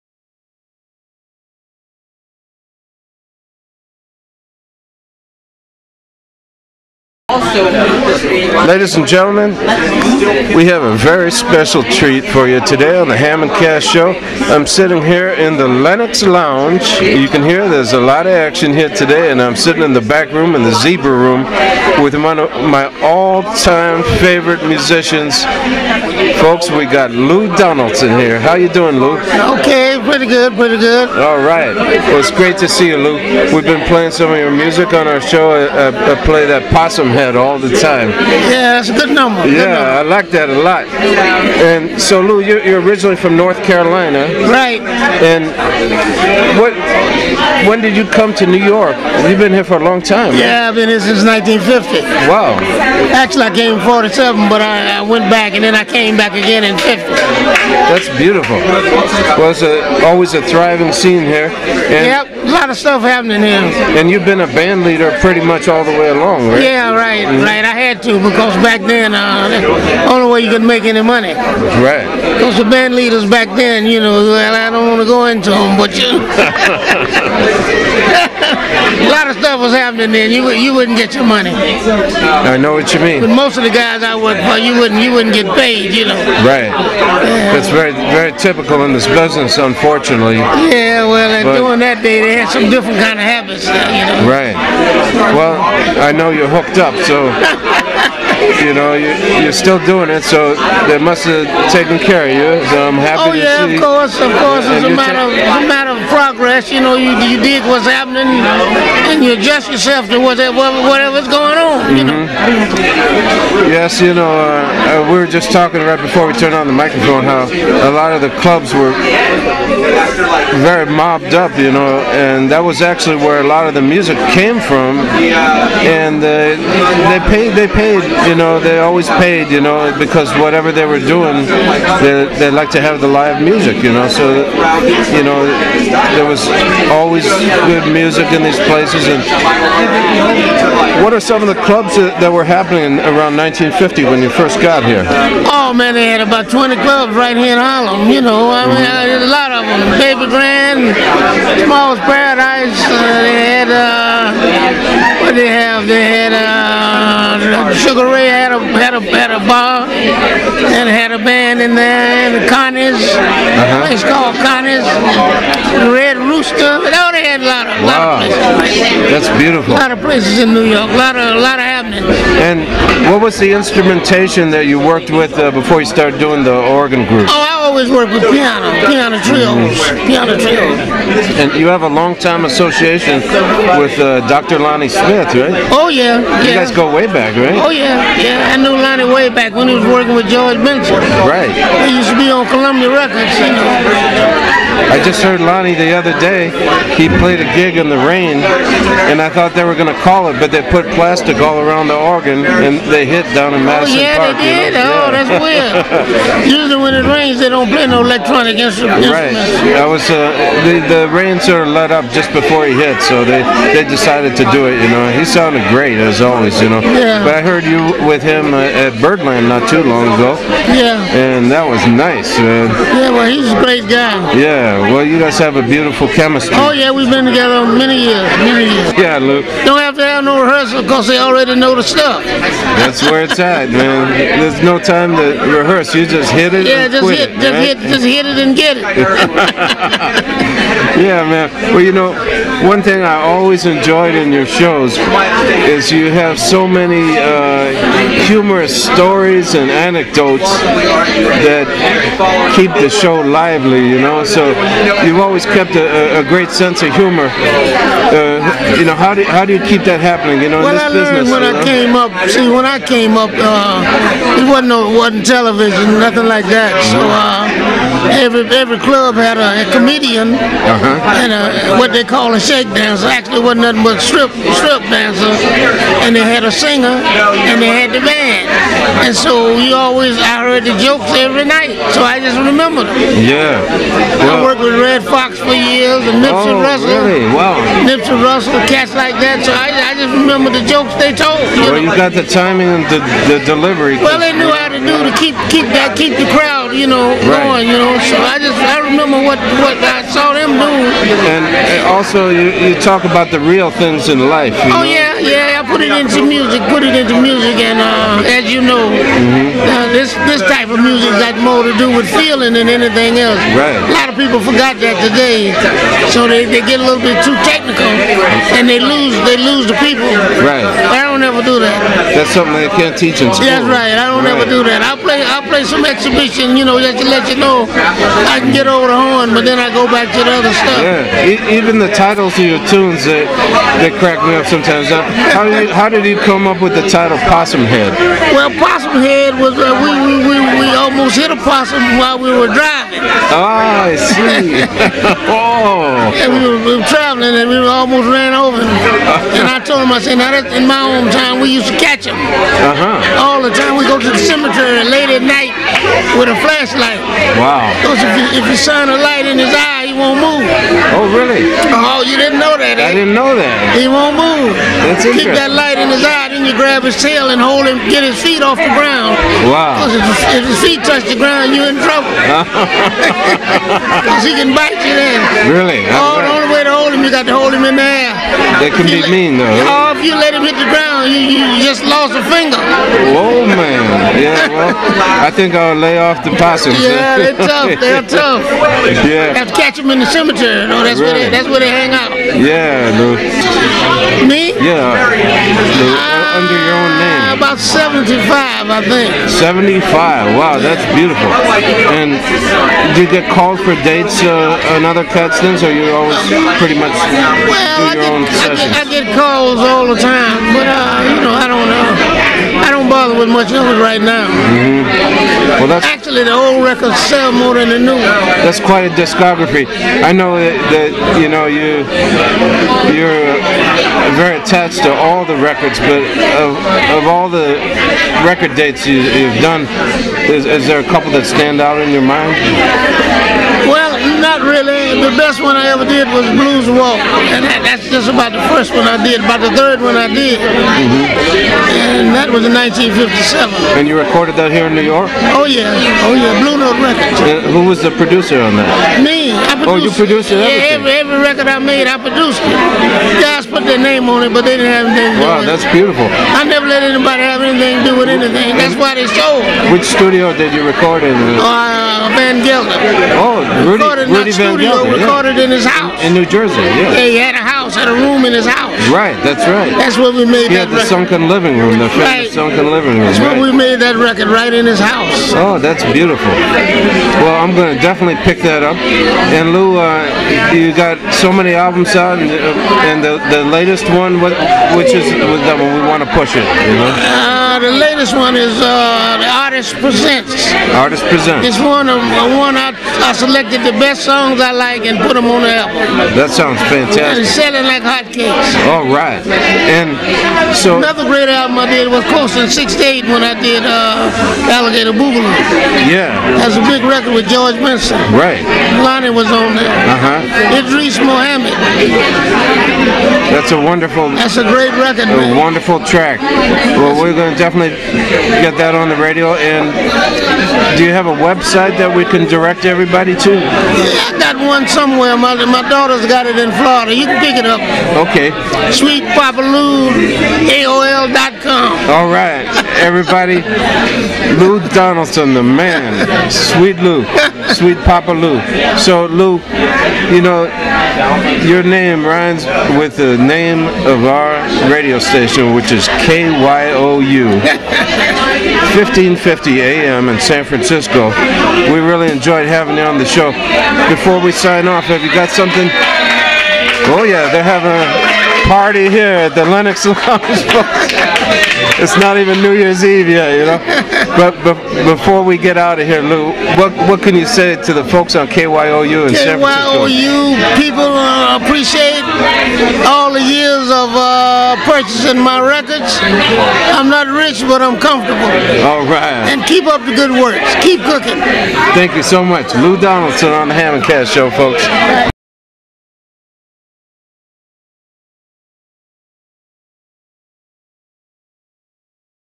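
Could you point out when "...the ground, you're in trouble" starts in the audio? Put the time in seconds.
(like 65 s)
371 s.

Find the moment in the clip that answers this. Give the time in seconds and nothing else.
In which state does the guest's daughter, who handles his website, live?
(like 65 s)
526 s.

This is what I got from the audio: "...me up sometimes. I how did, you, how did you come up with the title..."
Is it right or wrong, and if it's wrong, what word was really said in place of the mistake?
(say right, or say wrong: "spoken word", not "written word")
right.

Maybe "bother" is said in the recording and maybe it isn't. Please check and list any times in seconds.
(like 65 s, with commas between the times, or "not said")
412 s.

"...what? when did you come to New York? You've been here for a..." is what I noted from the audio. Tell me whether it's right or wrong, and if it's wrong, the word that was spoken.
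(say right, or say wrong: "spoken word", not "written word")
right.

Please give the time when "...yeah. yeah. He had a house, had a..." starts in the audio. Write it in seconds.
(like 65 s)
466 s.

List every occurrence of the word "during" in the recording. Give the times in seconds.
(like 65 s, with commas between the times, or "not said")
91 s.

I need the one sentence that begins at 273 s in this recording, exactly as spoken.
Actually, wasn't nothing but strip strip dancer, and they had a singer and they had the band.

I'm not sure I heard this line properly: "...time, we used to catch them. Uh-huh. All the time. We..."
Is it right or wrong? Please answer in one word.
right.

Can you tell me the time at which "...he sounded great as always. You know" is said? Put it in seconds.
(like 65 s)
215 s.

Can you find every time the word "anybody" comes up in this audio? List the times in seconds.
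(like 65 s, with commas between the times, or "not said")
456 s.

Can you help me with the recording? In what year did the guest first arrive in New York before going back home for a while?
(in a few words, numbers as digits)
1947.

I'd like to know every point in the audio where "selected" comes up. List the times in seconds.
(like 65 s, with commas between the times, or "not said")
493 s.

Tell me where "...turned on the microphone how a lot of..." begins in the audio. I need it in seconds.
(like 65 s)
116 s.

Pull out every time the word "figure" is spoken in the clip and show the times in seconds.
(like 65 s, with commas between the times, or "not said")
not said.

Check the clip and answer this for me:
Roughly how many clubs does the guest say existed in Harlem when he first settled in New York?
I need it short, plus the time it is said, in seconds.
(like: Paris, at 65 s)
20, at 146 s.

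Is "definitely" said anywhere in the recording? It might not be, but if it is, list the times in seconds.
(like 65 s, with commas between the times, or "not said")
477 s, 517 s.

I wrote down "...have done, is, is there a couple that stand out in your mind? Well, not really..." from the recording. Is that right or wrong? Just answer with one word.
right.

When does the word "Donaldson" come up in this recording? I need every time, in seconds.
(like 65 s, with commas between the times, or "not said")
27 s, 534 s, 582 s.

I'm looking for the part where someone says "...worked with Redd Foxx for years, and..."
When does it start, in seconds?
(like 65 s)
284 s.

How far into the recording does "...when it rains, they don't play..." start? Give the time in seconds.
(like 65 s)
206 s.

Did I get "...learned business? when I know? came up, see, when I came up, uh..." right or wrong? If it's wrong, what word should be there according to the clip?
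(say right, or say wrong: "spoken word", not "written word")
right.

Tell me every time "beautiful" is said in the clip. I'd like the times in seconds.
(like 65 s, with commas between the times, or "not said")
58 s, 169 s, 225 s, 400 s, 455 s, 475 s.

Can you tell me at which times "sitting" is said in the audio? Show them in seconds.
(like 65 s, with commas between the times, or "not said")
14 s, 19 s.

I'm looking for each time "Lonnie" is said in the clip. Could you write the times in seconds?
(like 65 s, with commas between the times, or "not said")
184 s, 188 s, 195 s, 508 s.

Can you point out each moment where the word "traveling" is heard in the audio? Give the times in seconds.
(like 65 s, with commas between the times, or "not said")
346 s.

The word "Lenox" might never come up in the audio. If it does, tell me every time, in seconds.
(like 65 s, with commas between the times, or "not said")
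15 s, 559 s.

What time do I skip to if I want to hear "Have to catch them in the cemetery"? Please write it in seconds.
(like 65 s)
389 s.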